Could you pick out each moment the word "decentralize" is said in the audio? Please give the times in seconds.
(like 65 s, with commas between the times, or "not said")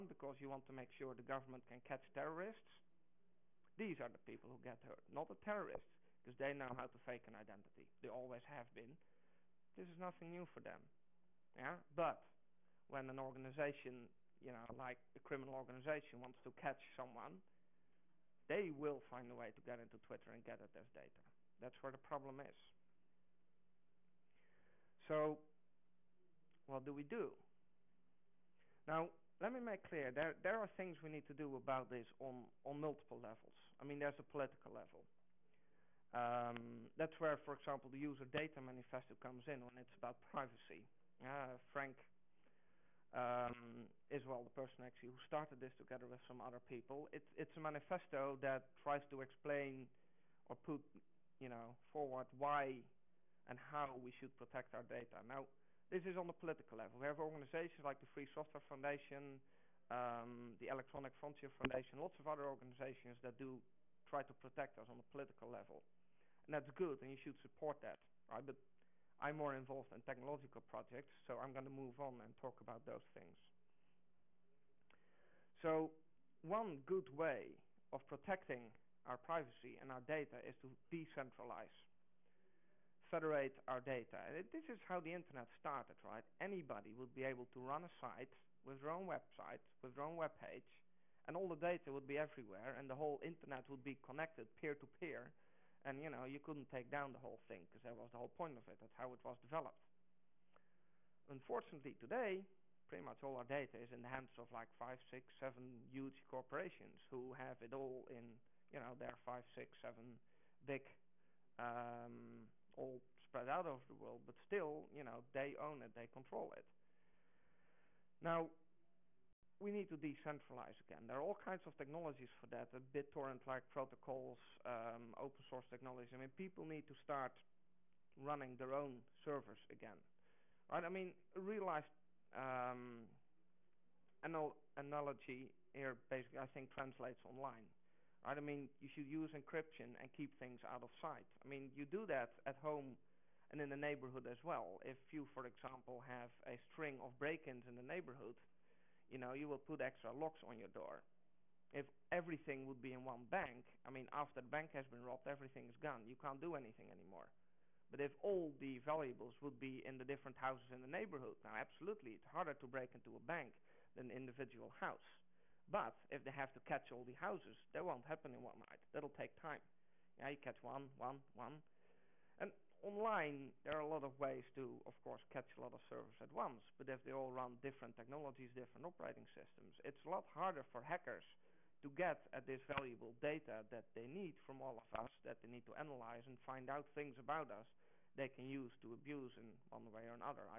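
80 s, 119 s.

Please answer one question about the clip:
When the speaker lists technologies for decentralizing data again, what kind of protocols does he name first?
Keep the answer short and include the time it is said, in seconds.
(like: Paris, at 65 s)
BitTorrent-like protocols, at 122 s.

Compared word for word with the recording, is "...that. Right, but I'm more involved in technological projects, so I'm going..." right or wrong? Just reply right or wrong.
right.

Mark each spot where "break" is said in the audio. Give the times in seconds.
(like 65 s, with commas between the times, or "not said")
147 s, 162 s.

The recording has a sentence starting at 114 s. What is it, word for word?
But still, you know, they own it, they control it.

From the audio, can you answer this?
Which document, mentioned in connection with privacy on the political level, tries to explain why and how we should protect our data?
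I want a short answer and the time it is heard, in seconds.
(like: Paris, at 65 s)
User data manifesto, at 37 s.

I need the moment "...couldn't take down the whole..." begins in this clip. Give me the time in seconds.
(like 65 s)
96 s.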